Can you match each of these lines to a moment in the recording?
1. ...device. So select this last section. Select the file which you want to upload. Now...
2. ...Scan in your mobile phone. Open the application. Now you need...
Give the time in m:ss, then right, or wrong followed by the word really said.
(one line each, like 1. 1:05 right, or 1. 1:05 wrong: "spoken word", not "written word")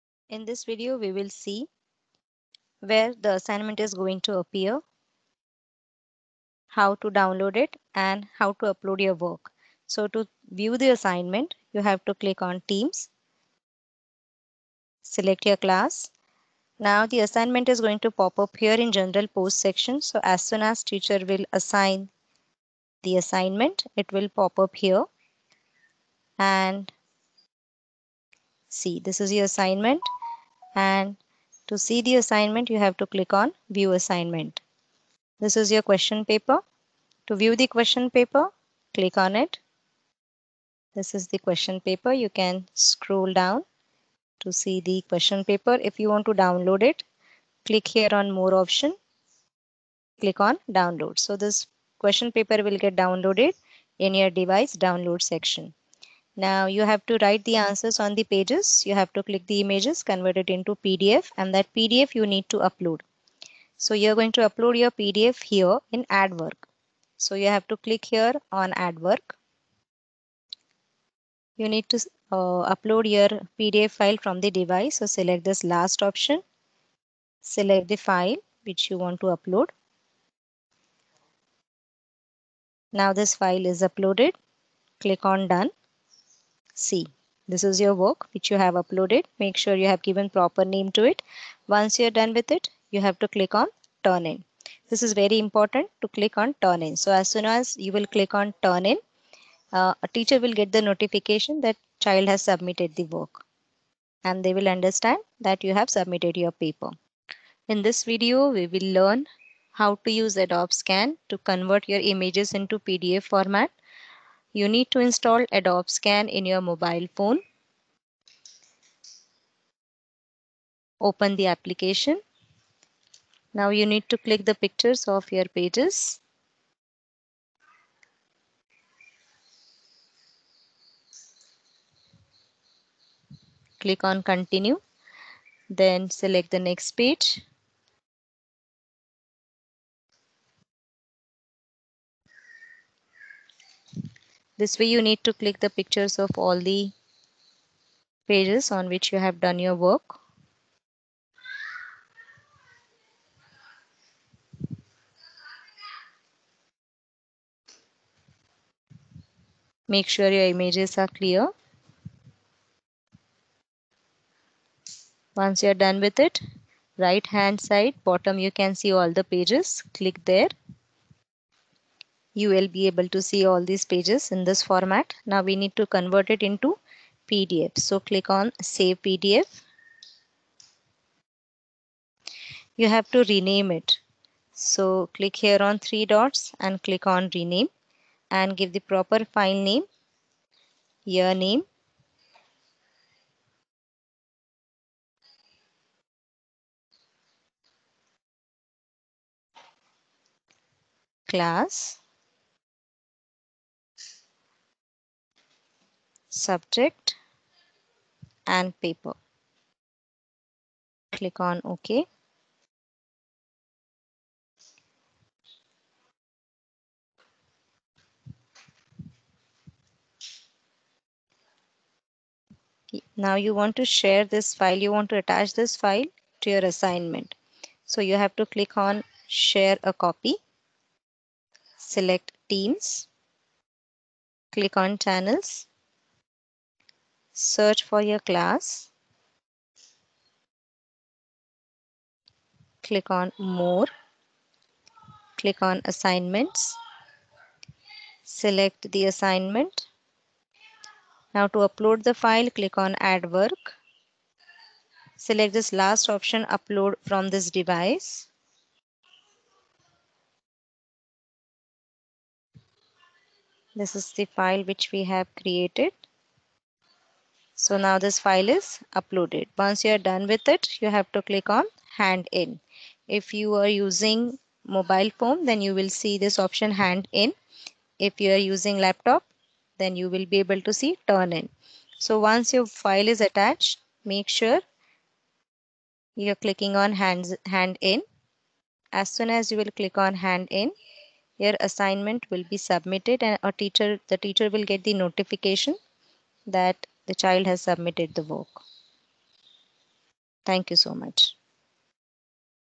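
1. 1:14 wrong: "option", not "section"
2. 1:55 right.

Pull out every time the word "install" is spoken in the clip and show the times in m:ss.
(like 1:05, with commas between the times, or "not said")
1:54.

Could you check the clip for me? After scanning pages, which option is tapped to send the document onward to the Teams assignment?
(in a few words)
Share a copy.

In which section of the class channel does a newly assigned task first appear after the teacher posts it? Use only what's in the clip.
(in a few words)
General post section.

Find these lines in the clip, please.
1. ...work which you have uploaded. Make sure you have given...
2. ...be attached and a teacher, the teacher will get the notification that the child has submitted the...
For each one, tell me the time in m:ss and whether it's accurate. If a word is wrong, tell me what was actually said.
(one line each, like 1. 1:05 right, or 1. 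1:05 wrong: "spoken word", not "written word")
1. 1:27 right
2. 4:52 wrong: "submitted", not "attached".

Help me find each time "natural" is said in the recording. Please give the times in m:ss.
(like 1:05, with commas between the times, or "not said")
not said.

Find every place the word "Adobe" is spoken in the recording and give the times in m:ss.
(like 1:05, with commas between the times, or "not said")
1:50, 1:55.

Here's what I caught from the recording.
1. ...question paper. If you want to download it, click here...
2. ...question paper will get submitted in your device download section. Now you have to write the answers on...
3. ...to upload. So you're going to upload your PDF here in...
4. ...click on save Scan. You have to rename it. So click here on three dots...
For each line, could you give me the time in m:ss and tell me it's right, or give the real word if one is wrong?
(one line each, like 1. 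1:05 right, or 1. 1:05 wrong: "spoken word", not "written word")
1. 0:45 right
2. 0:51 wrong: "downloaded", not "submitted"
3. 1:02 right
4. 2:57 wrong: "PDF", not "Scan".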